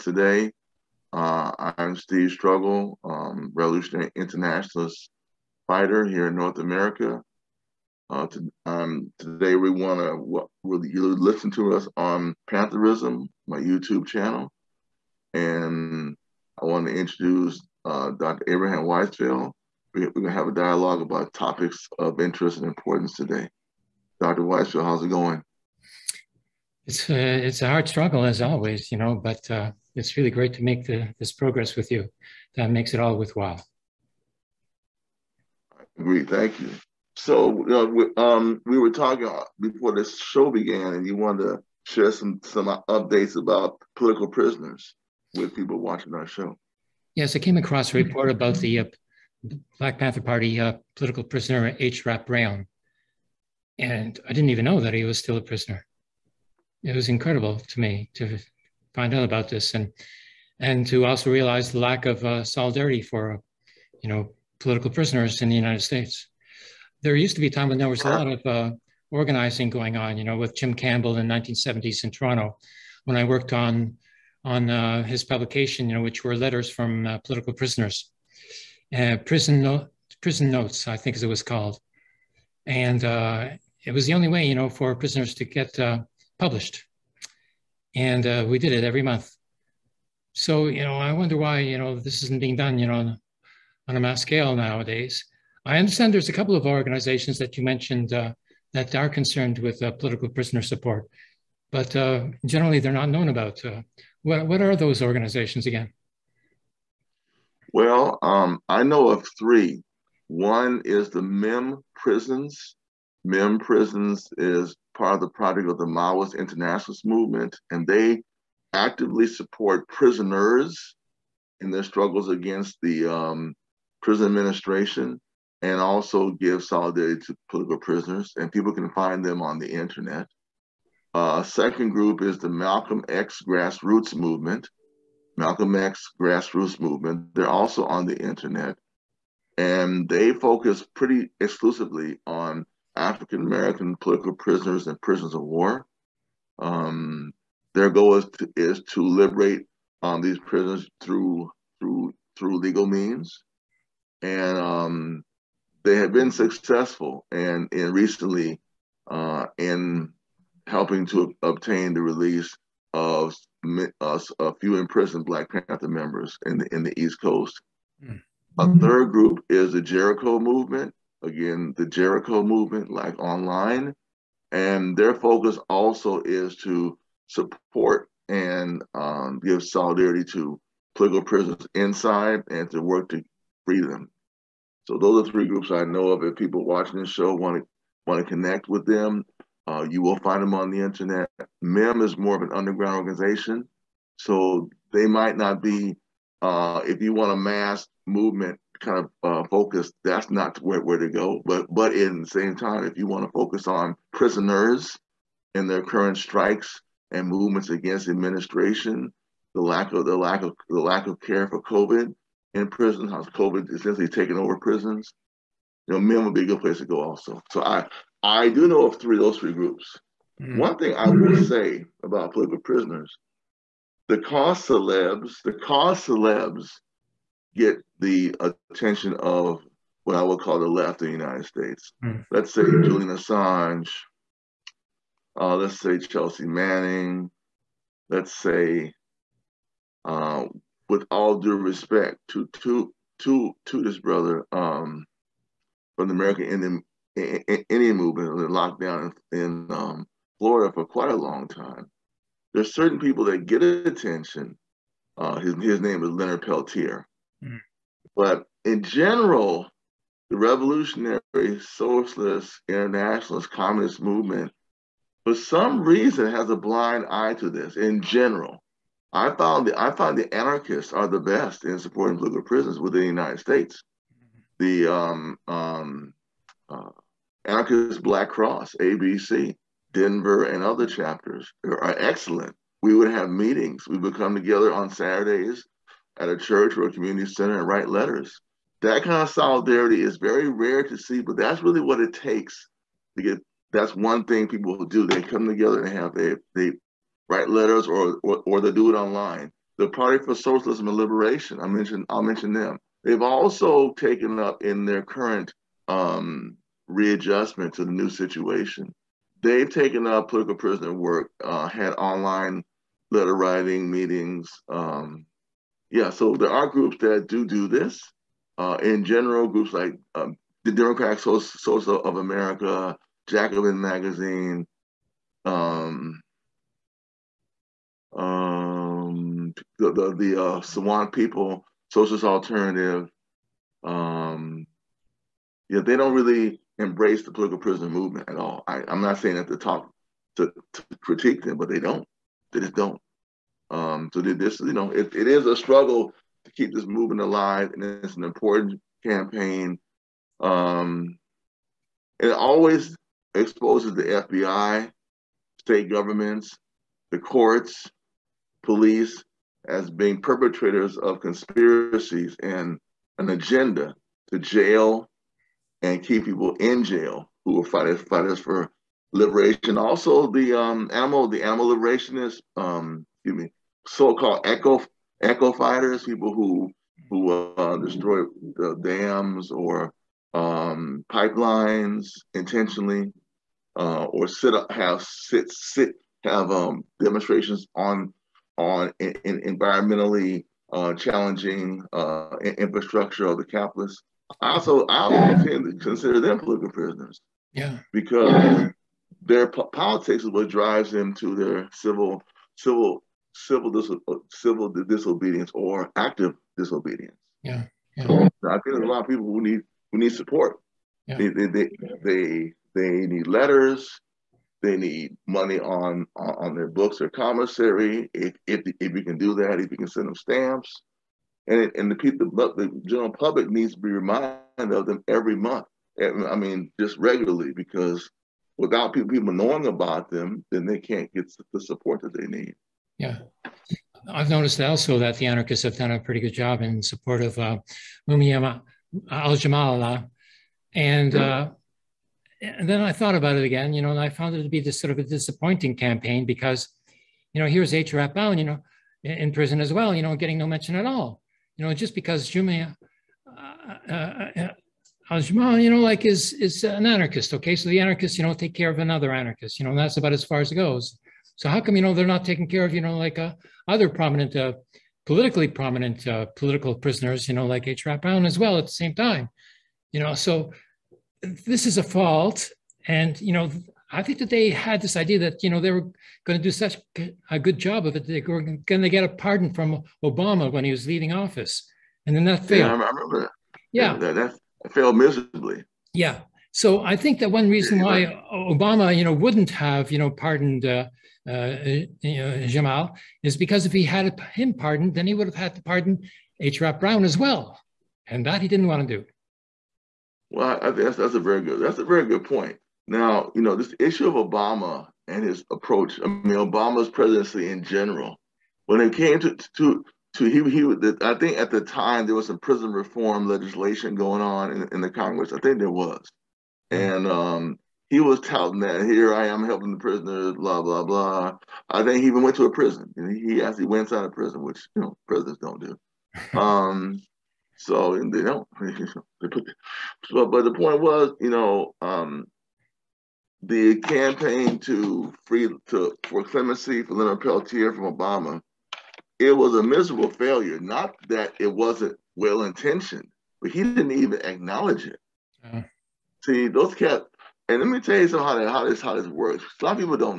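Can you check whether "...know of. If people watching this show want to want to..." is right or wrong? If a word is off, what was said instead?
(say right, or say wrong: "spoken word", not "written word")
right.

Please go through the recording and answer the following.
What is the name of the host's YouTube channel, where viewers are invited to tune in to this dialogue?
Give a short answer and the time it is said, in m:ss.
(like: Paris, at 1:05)
Pantherism, at 0:12.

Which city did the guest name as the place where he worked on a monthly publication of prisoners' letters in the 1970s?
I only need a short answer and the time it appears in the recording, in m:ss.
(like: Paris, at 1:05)
Toronto, at 1:12.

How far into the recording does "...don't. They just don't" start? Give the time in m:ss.
5:41.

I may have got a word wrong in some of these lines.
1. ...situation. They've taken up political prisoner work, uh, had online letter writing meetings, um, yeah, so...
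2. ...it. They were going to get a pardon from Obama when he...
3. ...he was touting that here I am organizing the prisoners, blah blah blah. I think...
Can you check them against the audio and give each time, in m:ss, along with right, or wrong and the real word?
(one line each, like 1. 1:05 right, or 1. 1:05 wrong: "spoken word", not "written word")
1. 5:08 right
2. 7:57 right
3. 8:37 wrong: "helping", not "organizing".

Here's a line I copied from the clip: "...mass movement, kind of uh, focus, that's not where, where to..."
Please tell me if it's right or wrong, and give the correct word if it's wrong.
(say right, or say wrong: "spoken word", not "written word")
right.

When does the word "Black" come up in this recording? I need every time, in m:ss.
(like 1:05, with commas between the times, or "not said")
0:49, 2:45, 4:38.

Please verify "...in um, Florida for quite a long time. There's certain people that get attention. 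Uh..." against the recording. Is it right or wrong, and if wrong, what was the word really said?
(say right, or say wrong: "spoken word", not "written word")
right.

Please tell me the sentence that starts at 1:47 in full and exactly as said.
Well, um, I know of three.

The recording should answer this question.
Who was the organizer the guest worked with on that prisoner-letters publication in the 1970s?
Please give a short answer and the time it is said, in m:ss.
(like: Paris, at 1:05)
Jim Campbell, at 1:10.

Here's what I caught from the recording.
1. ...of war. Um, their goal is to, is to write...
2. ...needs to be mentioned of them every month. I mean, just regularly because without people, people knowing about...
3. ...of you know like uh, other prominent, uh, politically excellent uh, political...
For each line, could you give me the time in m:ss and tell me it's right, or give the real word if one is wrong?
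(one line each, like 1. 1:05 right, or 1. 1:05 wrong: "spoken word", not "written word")
1. 2:25 wrong: "liberate", not "write"
2. 7:03 wrong: "reminded", not "mentioned"
3. 7:42 wrong: "prominent", not "excellent".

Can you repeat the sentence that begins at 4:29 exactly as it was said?
I found the I find the anarchists are the best in supporting political prisoners within the United States.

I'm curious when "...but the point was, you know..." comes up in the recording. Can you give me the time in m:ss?
8:50.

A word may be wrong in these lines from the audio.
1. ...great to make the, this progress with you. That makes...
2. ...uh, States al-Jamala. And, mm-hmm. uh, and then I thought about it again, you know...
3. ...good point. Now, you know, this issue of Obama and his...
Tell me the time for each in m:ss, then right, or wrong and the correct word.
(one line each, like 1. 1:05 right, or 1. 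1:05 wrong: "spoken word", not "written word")
1. 0:30 right
2. 7:17 wrong: "Mumiyama", not "States"
3. 8:22 right.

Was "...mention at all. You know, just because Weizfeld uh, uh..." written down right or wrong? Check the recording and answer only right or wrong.
wrong.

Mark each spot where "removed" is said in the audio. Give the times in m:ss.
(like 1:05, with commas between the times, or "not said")
not said.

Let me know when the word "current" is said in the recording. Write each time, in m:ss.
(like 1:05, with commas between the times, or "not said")
3:25, 5:05.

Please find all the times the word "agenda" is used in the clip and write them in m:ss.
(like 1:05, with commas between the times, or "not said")
6:03.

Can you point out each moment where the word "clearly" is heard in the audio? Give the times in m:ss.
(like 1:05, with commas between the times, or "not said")
not said.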